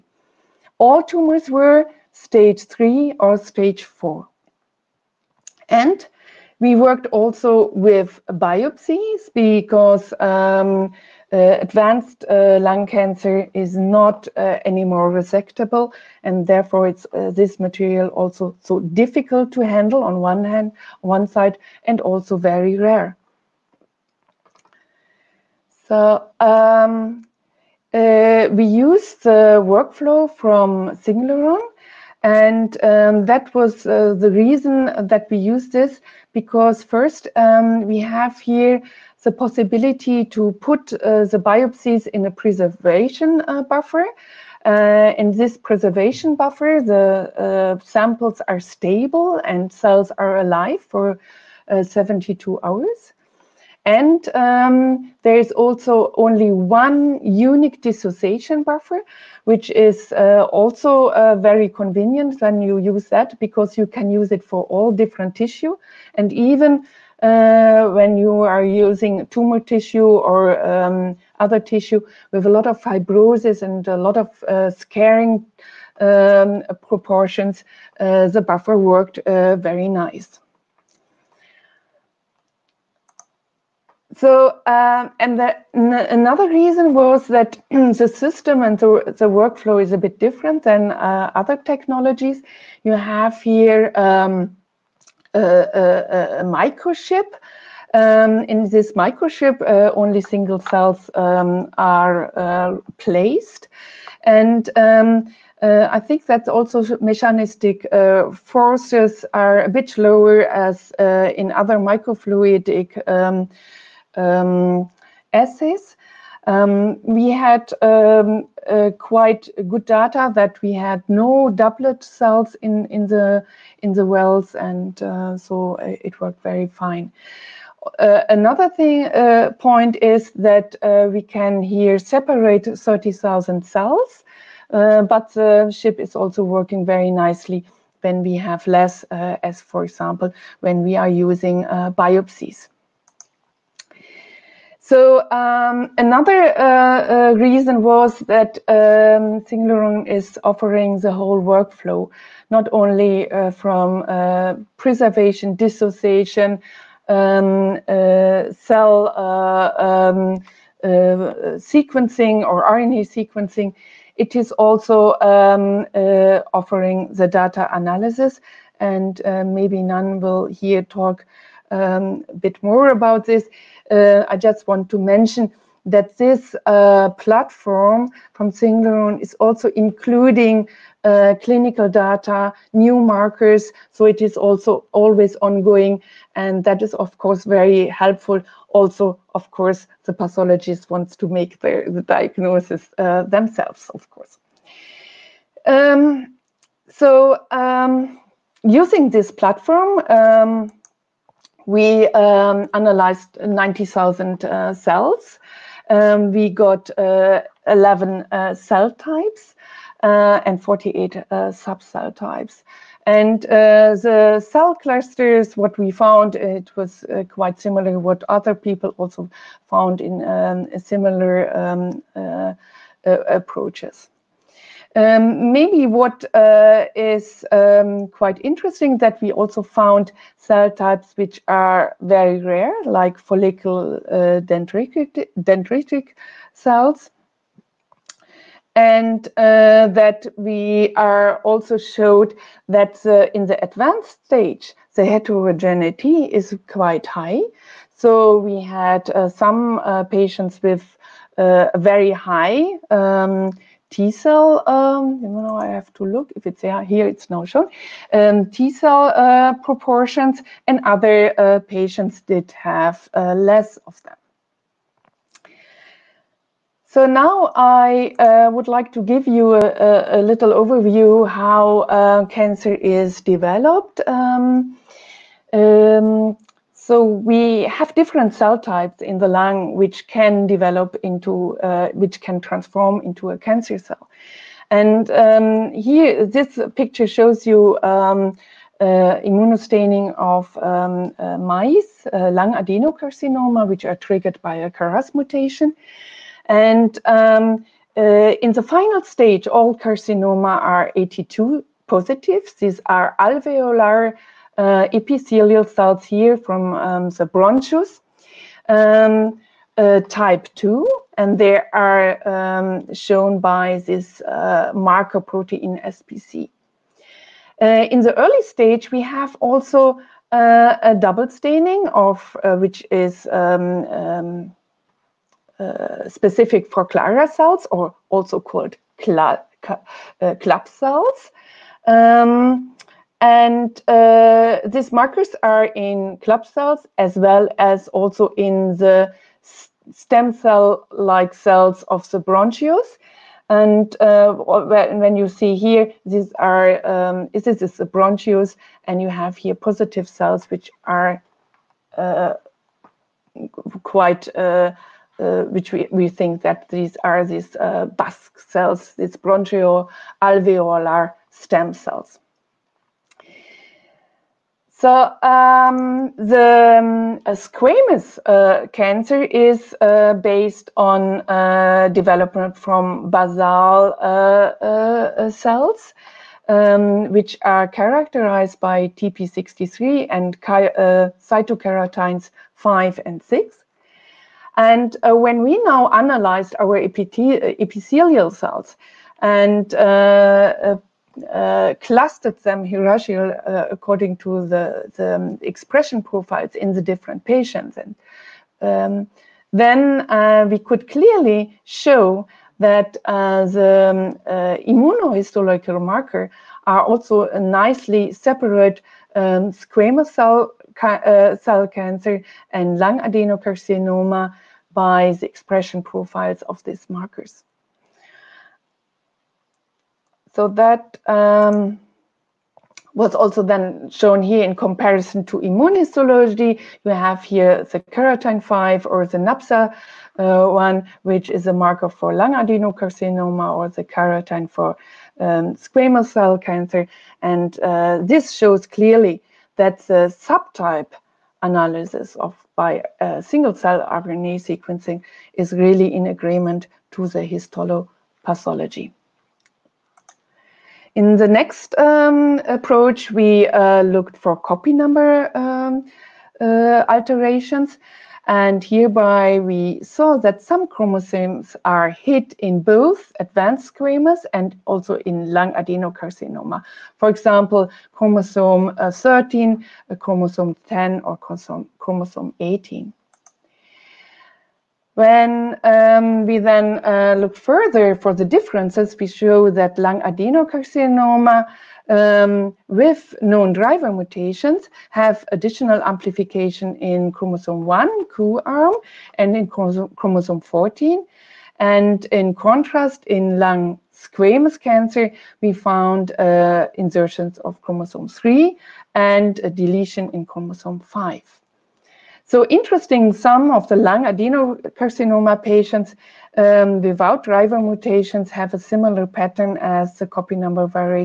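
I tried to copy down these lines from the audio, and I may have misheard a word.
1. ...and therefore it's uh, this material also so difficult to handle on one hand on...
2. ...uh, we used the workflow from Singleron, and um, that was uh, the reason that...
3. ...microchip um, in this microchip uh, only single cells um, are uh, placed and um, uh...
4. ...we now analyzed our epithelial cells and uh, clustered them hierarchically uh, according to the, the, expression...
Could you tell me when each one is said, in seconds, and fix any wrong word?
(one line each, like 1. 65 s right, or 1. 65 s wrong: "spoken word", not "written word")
1. 16 s right
2. 27 s right
3. 96 s right
4. 385 s right.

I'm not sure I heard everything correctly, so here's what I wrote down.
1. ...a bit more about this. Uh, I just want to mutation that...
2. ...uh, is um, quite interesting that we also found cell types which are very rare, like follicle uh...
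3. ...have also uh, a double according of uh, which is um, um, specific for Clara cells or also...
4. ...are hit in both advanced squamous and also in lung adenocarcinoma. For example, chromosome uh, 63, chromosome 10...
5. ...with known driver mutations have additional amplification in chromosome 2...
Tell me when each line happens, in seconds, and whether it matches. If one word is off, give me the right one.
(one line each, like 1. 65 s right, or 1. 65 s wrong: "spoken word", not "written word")
1. 172 s wrong: "mention", not "mutation"
2. 226 s right
3. 319 s wrong: "staining", not "according"
4. 461 s wrong: "13", not "63"
5. 482 s wrong: "1", not "2".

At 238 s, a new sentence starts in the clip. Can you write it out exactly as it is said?
And uh, that we are also showed that uh, in the advanced stage, the heterogeneity is quite high.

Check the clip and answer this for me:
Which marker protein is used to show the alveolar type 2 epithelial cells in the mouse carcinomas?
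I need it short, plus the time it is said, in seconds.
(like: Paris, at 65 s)
SPC, at 315 s.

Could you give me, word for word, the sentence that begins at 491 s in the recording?
And in contrast, in lung squamous cancer, we found uh, insertions of chromosome 3 and a deletion in chromosome 5.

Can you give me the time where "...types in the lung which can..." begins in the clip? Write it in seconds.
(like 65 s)
278 s.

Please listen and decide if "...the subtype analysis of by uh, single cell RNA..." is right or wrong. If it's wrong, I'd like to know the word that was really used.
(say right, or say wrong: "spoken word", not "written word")
right.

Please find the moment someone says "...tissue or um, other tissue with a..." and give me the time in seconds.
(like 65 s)
69 s.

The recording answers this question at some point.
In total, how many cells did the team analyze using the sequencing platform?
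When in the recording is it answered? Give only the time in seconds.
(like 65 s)
203 s.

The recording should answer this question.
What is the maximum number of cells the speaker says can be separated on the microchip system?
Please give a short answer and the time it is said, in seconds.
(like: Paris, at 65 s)
30,000, at 132 s.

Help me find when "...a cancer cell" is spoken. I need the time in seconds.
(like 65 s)
283 s.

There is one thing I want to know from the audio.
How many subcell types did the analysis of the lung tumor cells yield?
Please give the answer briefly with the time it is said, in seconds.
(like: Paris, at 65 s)
48, at 210 s.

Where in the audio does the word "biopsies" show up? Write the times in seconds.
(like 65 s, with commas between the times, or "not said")
8 s, 41 s, 141 s.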